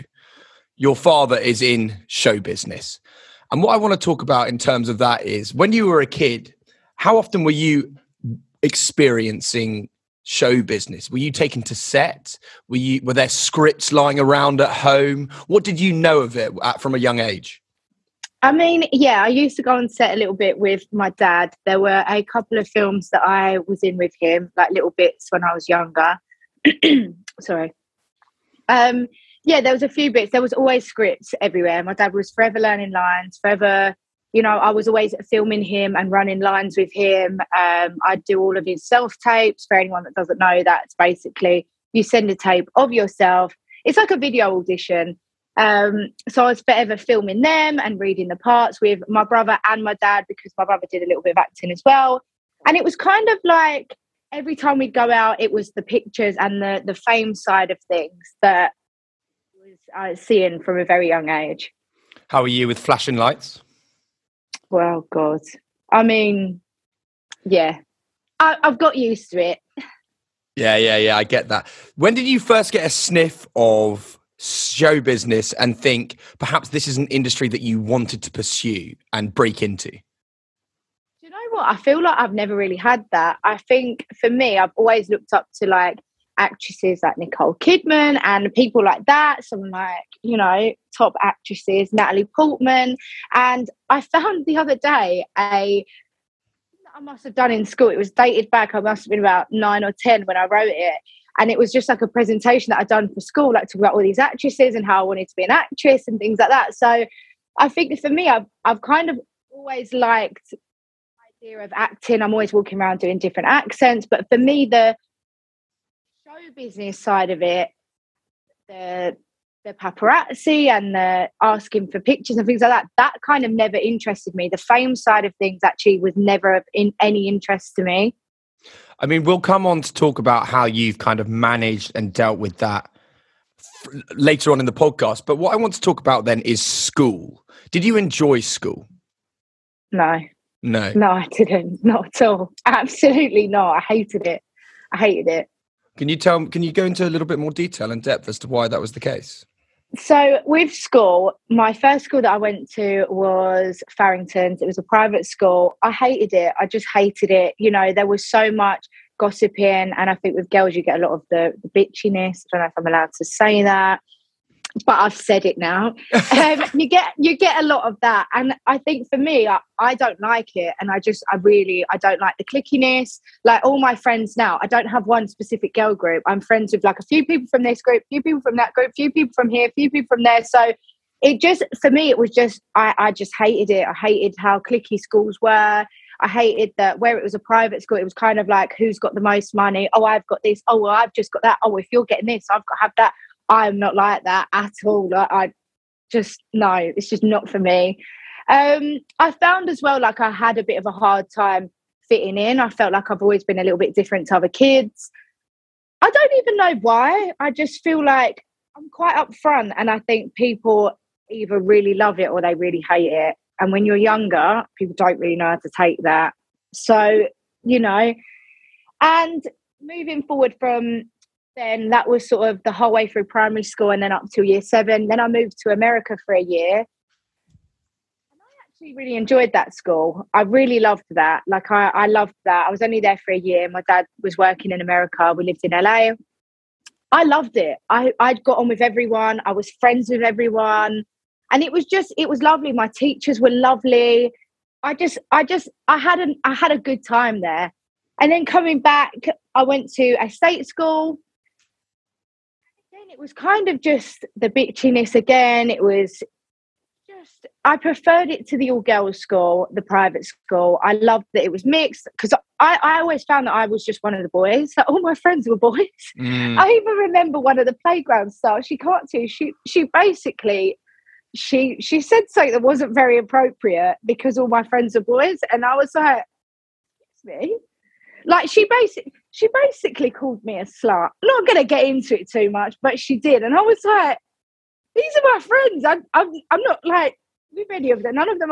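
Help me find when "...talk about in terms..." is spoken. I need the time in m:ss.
0:04.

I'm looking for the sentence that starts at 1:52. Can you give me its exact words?
I'm always walking around doing different accents.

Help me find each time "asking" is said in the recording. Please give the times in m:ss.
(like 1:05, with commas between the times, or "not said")
2:01.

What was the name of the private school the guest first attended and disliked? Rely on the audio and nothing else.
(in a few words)
Farrington's.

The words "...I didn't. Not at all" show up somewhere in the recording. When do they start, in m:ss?
2:21.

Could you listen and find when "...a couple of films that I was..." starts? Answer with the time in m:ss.
0:22.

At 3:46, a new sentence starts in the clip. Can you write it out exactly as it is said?
And I actually really enjoyed that school.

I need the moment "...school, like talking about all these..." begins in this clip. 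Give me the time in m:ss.
1:43.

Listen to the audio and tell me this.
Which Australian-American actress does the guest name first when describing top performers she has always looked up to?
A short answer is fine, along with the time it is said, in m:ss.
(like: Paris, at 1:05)
Nicole Kidman, at 1:27.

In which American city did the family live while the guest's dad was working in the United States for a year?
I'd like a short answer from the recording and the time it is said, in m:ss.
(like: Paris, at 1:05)
LA, at 3:55.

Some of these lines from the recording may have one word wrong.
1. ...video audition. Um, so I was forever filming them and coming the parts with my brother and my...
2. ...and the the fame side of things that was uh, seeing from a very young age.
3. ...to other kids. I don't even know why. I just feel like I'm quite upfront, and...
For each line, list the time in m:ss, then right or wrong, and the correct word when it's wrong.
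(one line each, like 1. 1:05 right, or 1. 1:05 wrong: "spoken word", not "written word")
1. 0:44 wrong: "reading", not "coming"
2. 0:56 right
3. 3:24 right.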